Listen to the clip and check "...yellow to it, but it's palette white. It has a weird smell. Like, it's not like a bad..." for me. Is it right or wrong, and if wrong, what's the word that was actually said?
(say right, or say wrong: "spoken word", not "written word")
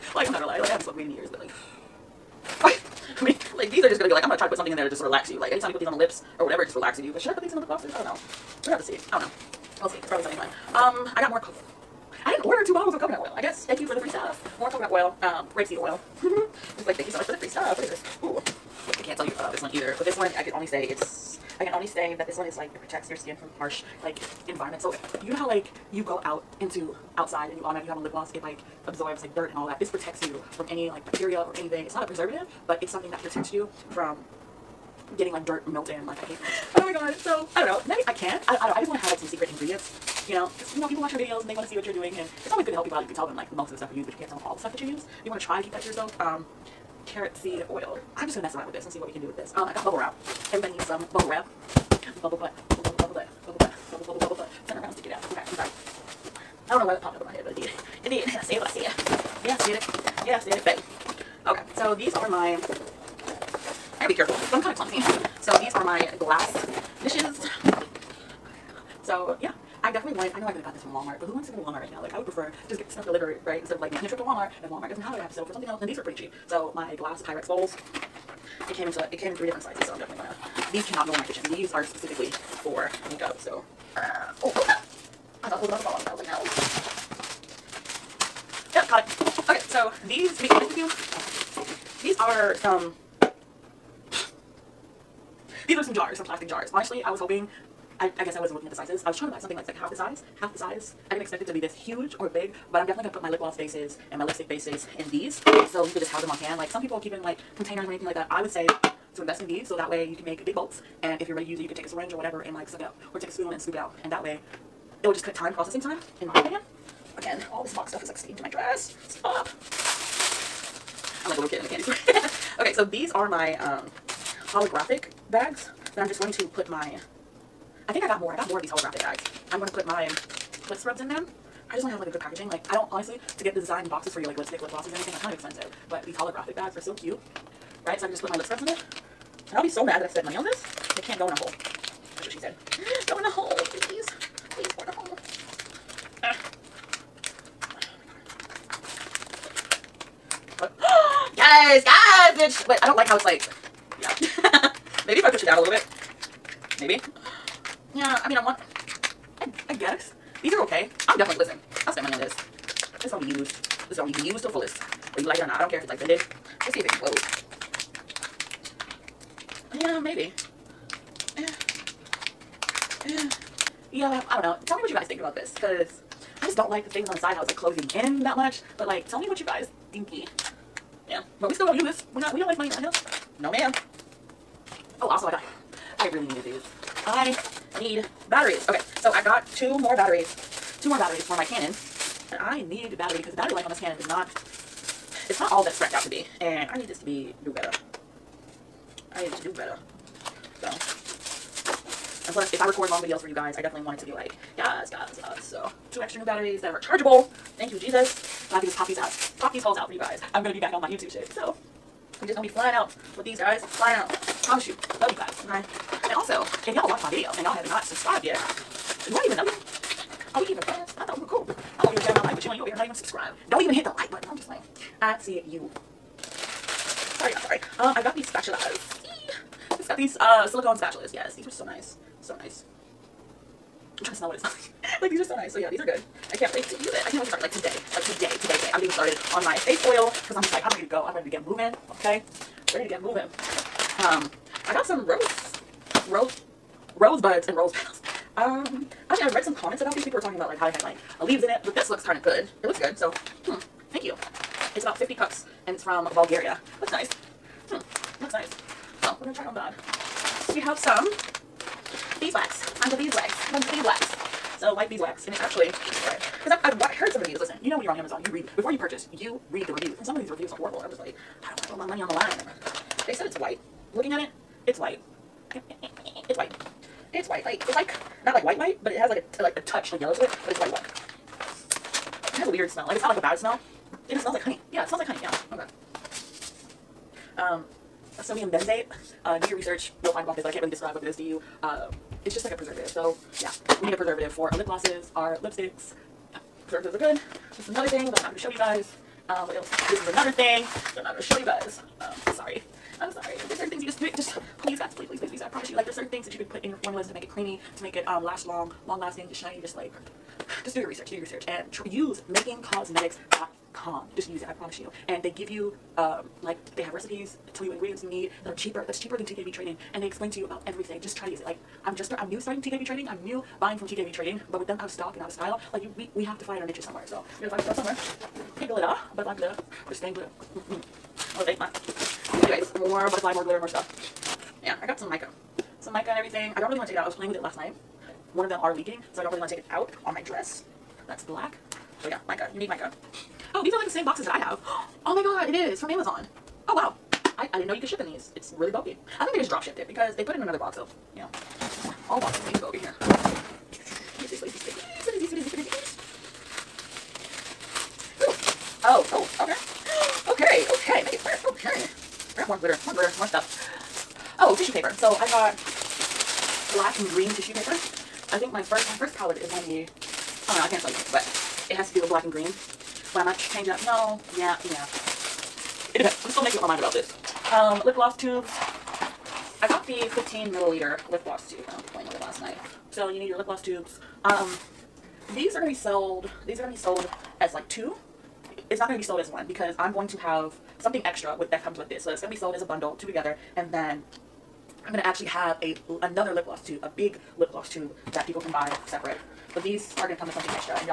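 wrong: "white", not "palette".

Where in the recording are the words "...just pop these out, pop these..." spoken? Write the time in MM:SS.
03:28.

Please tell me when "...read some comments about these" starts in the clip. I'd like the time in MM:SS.
04:09.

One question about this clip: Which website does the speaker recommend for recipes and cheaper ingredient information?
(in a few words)
makingcosmetics.com.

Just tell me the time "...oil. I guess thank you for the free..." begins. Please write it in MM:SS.
00:13.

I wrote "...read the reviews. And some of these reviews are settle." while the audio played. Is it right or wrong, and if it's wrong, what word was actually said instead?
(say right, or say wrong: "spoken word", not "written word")
wrong: "horrible", not "settle".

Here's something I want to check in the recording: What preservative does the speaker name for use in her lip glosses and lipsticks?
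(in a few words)
sodium benzoate.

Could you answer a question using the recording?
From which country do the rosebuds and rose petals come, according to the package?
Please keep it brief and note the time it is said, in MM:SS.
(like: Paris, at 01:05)
Bulgaria, at 04:16.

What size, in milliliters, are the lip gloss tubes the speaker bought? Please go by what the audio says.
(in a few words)
15.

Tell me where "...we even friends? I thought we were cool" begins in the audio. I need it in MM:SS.
03:40.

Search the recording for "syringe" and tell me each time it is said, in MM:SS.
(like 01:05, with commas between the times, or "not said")
01:51.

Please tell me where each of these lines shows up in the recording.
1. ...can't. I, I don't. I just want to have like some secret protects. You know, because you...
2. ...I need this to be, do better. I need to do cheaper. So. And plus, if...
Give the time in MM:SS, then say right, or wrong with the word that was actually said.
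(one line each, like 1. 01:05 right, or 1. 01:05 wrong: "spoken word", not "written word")
1. 00:38 wrong: "ingredients", not "protects"
2. 03:16 wrong: "better", not "cheaper".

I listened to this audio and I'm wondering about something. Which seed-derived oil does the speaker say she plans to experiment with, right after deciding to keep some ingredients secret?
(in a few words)
carrot seed oil.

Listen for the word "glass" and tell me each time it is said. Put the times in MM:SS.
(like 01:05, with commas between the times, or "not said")
01:06, 01:16.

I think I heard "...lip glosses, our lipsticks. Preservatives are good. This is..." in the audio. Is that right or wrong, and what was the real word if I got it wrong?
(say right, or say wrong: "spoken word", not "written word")
right.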